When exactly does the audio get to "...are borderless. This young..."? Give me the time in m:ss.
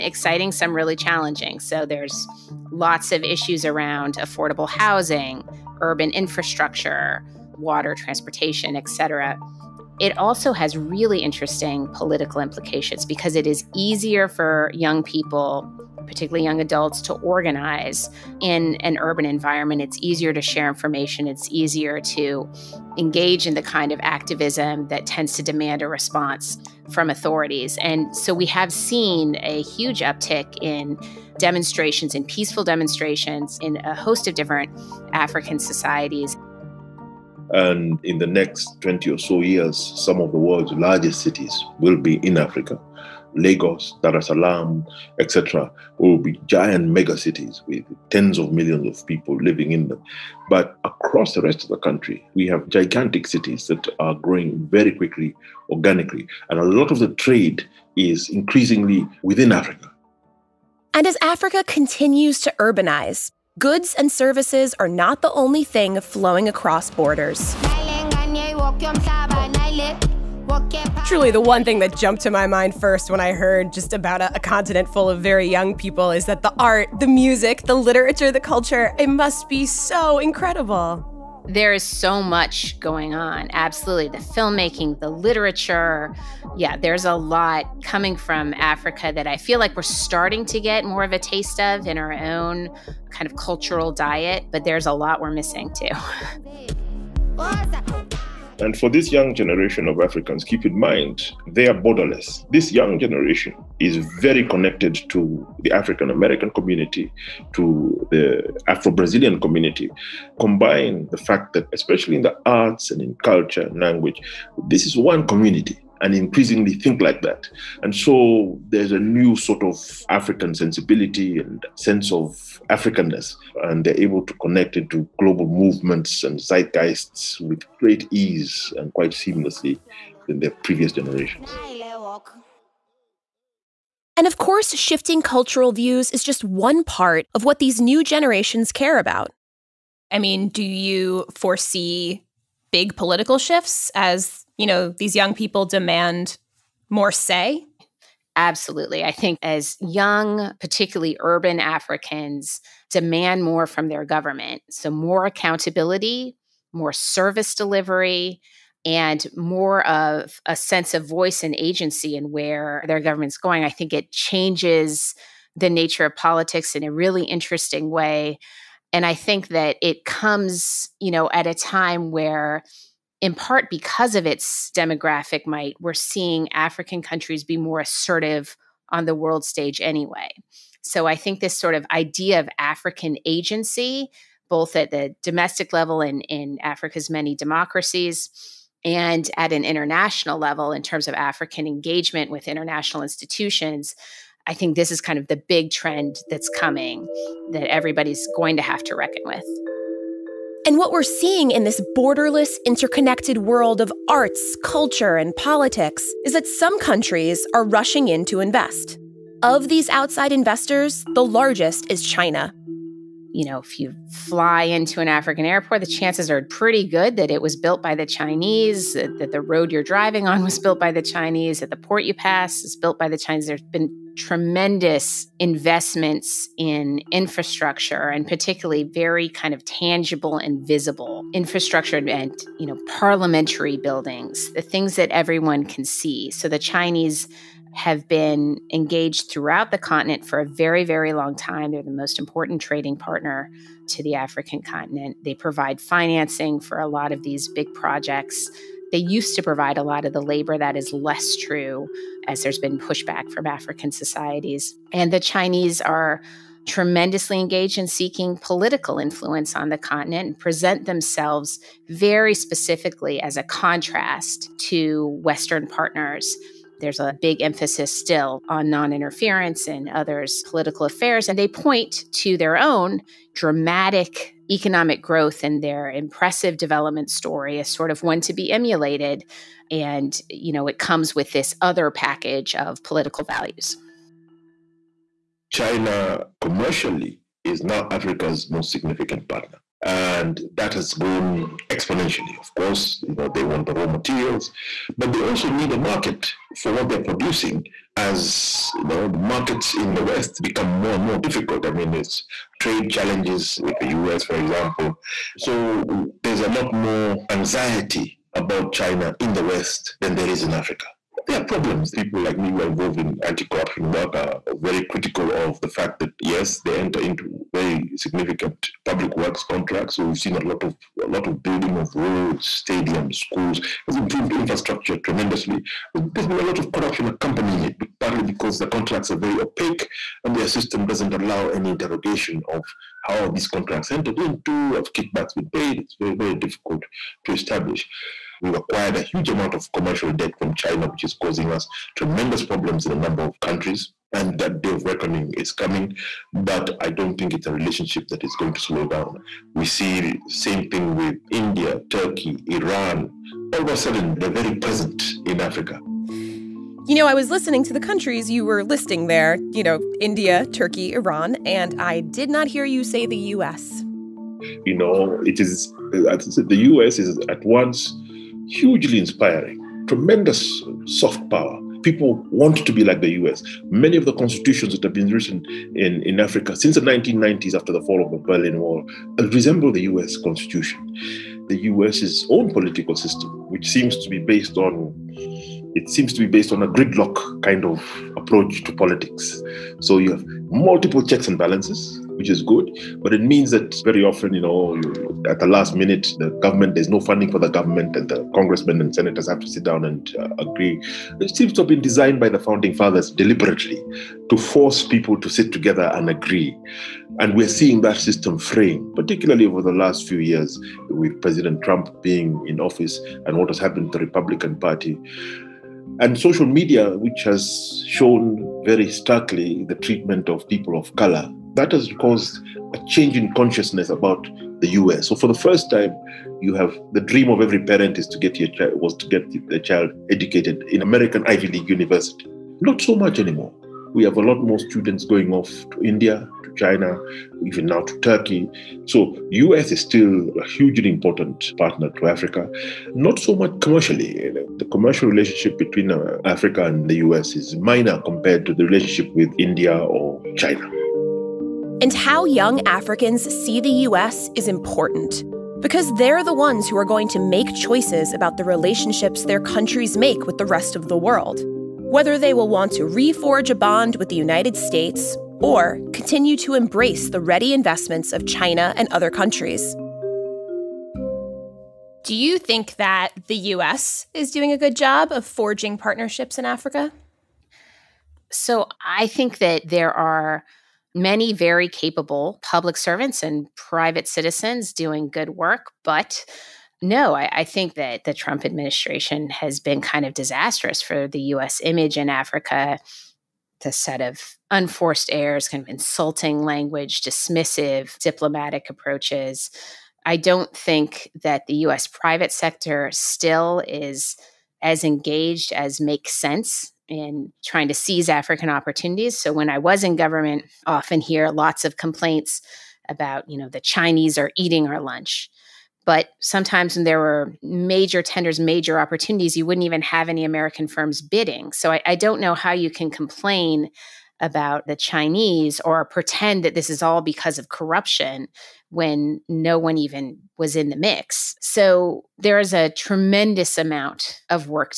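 1:41.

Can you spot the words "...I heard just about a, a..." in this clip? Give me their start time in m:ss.
1:13.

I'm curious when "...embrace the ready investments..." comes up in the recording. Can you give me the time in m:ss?
7:46.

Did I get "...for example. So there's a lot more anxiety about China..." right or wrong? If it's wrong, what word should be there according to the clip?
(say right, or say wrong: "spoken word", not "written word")
right.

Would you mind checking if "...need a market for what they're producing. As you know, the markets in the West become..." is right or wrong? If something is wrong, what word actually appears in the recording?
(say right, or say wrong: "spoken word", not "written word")
right.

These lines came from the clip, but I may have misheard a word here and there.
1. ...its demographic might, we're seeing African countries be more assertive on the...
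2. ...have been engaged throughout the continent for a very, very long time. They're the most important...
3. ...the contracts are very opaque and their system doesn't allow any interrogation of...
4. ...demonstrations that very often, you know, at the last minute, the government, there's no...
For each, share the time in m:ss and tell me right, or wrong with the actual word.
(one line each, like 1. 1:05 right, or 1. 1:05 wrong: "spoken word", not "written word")
1. 2:54 right
2. 3:57 right
3. 5:28 right
4. 6:33 wrong: "means", not "demonstrations".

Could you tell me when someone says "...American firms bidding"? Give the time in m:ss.
8:40.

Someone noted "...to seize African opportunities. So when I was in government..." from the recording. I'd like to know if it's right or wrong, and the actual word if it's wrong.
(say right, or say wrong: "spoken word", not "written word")
right.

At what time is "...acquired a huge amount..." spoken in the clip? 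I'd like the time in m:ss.
5:38.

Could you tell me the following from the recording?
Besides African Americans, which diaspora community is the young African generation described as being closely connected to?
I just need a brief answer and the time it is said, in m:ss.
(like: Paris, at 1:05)
Afro Brazilian community, at 1:48.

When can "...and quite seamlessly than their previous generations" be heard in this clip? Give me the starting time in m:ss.
2:08.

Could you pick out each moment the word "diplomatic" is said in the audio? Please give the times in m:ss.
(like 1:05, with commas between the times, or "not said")
8:17.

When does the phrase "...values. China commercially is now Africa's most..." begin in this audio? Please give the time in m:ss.
4:43.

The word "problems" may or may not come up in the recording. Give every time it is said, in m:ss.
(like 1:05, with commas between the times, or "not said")
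5:11, 5:42.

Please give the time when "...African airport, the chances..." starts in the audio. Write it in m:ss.
3:35.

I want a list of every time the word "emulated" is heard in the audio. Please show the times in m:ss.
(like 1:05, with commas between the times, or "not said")
4:38.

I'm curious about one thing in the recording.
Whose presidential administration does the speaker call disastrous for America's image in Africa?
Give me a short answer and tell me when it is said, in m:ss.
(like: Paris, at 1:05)
Trump administration, at 8:08.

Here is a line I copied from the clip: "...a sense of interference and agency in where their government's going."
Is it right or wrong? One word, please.
wrong.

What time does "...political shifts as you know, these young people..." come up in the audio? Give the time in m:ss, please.
2:22.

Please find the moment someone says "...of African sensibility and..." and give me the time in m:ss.
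1:59.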